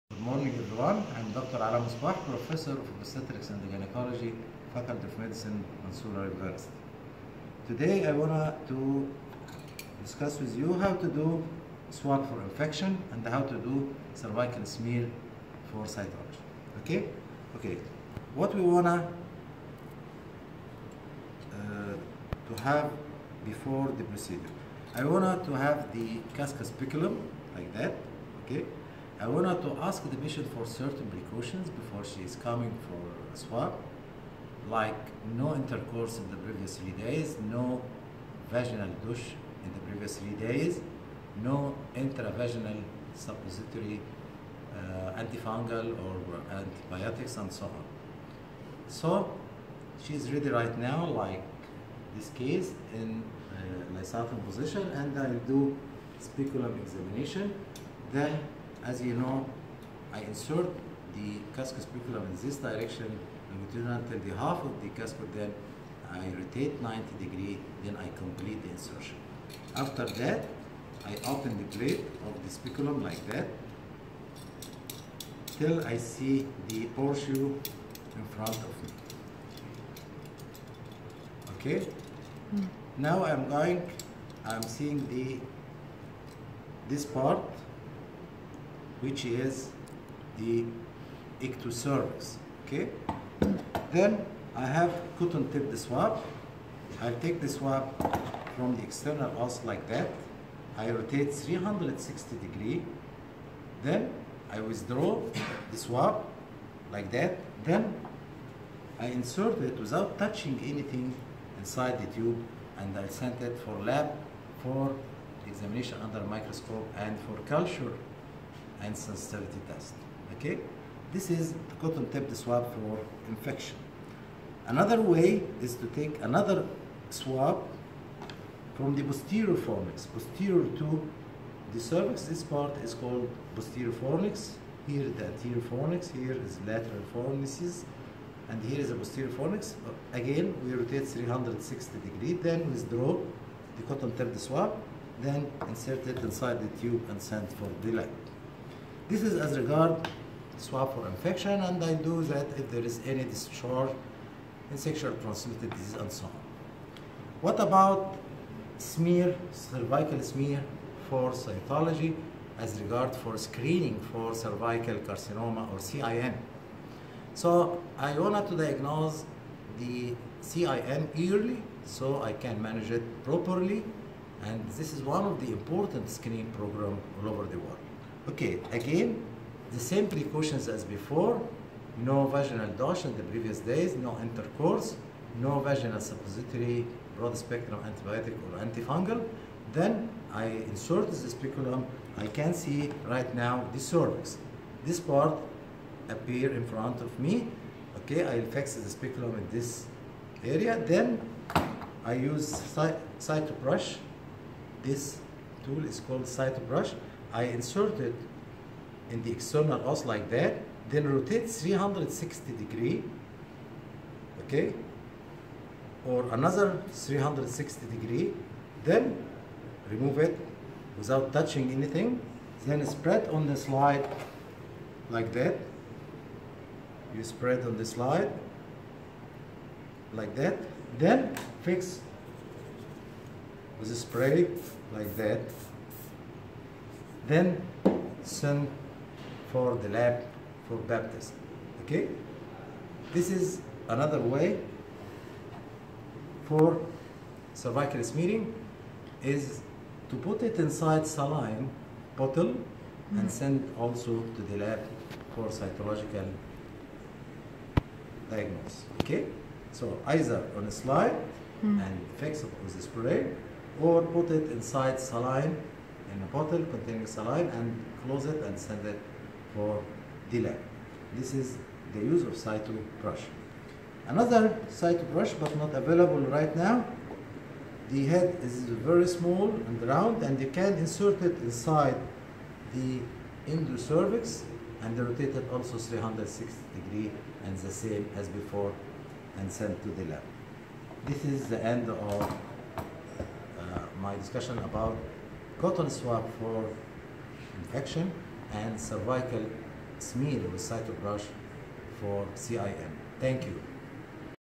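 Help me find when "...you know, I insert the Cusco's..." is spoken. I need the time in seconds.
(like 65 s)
59 s.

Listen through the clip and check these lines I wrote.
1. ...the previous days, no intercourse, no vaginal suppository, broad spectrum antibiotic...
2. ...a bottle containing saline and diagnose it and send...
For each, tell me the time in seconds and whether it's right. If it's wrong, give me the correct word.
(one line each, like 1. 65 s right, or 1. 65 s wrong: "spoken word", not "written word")
1. 183 s right
2. 266 s wrong: "close", not "diagnose".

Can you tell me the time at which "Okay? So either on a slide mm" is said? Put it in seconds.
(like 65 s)
259 s.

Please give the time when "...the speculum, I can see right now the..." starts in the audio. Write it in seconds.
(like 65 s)
191 s.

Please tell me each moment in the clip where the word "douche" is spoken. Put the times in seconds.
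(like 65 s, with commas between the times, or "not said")
39 s, 182 s.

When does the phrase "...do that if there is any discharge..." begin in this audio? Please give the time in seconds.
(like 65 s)
151 s.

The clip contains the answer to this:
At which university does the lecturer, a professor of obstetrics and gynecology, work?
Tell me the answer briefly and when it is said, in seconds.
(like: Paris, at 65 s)
Mansoura University, at 5 s.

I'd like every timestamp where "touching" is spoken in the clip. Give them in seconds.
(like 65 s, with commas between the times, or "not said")
110 s, 221 s.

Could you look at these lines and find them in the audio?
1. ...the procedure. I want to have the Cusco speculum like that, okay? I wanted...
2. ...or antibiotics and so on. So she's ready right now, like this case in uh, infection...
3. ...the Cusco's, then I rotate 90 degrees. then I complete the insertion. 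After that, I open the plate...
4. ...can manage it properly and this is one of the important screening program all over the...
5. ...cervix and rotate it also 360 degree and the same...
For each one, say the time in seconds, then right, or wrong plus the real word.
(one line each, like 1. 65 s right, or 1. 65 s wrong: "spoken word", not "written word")
1. 23 s right
2. 46 s wrong: "lysophon", not "infection"
3. 64 s right
4. 172 s right
5. 283 s right.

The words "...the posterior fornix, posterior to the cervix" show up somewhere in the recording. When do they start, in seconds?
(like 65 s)
128 s.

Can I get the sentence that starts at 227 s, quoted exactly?
You spread on the slide like that, then fix with a spray like that then send for the lab for baptism.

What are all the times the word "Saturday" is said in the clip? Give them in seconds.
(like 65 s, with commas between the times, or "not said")
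not said.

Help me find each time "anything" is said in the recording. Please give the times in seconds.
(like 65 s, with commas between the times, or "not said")
110 s, 221 s.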